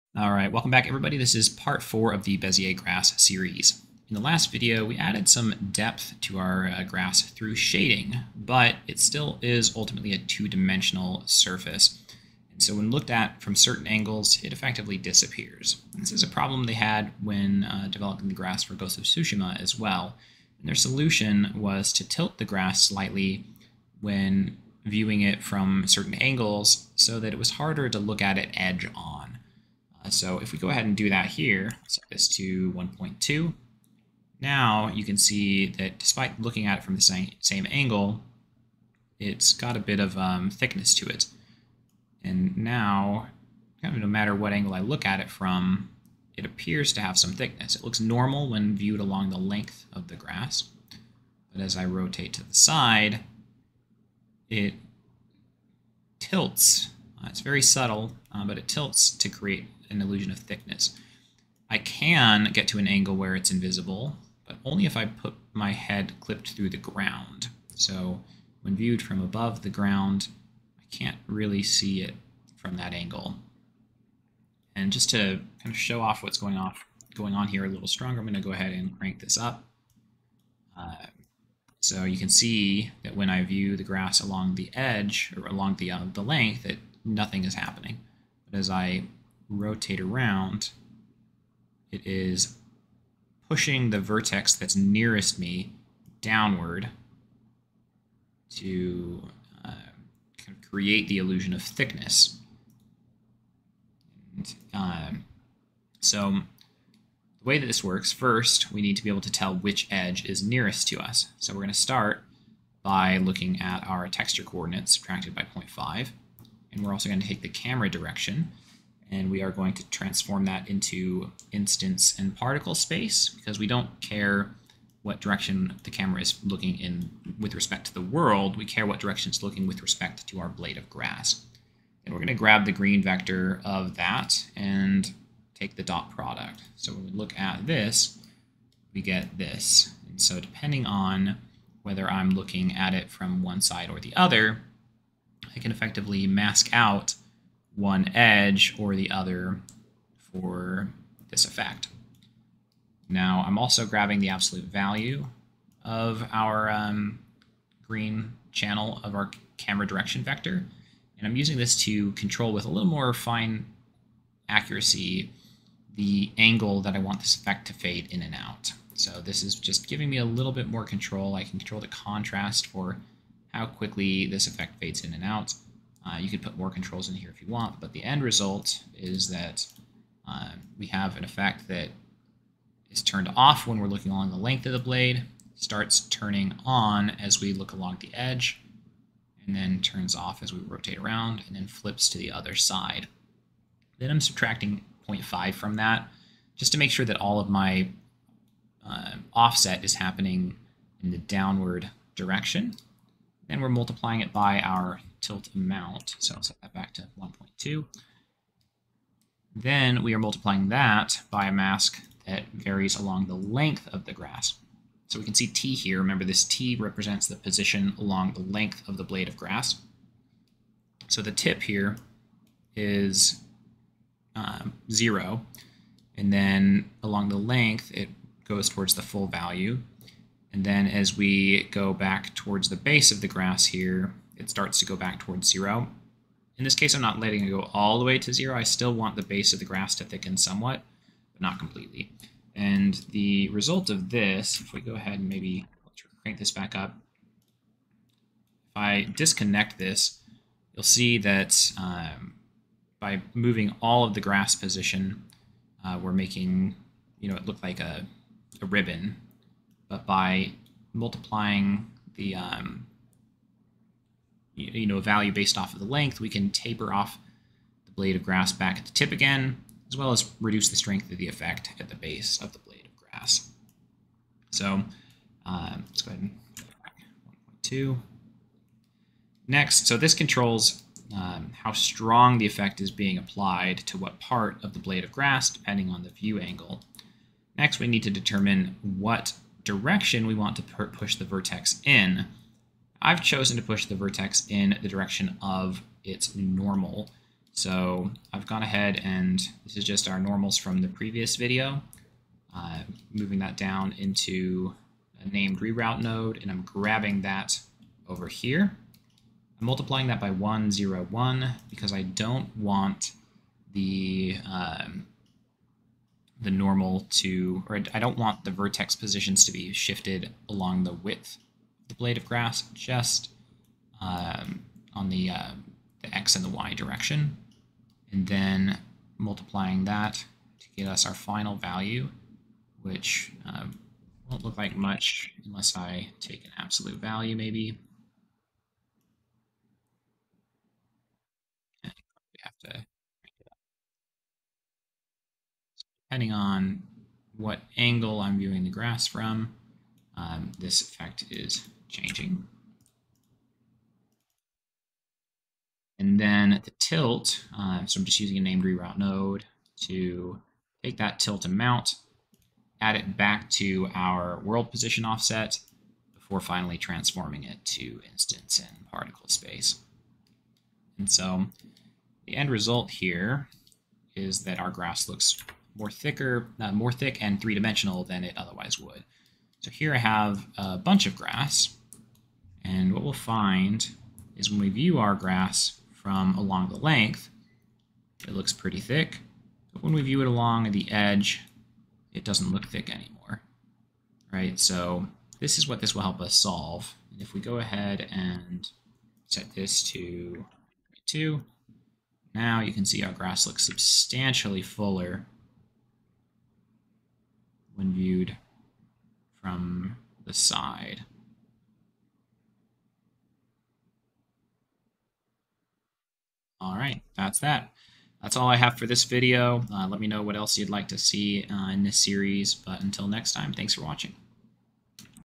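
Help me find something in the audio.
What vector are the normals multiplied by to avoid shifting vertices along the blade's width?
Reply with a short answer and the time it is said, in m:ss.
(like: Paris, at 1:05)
1, 0, 1, at 5:10.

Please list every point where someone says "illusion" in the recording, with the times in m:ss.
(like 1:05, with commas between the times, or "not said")
1:00, 1:41.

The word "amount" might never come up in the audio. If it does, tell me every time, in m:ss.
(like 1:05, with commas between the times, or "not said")
3:25, 6:01.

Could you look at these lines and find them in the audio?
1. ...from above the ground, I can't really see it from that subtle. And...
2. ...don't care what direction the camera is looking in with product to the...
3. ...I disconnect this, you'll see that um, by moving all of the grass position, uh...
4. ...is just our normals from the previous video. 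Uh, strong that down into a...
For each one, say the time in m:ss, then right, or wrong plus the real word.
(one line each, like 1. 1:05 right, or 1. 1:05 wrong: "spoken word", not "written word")
1. 1:09 wrong: "angle", not "subtle"
2. 2:03 wrong: "respect", not "product"
3. 4:08 right
4. 4:59 wrong: "moving", not "strong".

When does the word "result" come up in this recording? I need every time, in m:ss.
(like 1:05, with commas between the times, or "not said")
2:58, 4:03, 6:12.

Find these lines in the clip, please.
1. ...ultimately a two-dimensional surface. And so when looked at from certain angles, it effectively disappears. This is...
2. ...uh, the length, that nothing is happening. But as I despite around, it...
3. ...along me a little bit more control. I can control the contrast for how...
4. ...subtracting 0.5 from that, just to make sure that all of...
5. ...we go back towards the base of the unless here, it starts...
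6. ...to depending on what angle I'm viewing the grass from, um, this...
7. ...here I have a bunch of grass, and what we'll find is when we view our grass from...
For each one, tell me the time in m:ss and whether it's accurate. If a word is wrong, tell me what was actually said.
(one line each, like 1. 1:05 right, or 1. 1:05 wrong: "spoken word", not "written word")
1. 0:09 right
2. 1:25 wrong: "rotate", not "despite"
3. 2:49 wrong: "giving", not "along"
4. 3:14 right
5. 3:51 wrong: "grass", not "unless"
6. 5:42 right
7. 6:19 right.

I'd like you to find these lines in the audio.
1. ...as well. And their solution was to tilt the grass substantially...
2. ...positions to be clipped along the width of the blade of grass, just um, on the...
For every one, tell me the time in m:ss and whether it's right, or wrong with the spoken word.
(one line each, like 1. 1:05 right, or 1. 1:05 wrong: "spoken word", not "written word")
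1. 0:19 wrong: "slightly", not "substantially"
2. 5:18 wrong: "shifted", not "clipped".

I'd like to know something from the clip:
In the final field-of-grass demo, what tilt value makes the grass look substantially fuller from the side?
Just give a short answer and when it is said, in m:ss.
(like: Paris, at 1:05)
2, at 6:41.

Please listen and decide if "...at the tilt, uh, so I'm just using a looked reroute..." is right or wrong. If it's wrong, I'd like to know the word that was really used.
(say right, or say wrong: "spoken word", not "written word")
wrong: "named", not "looked".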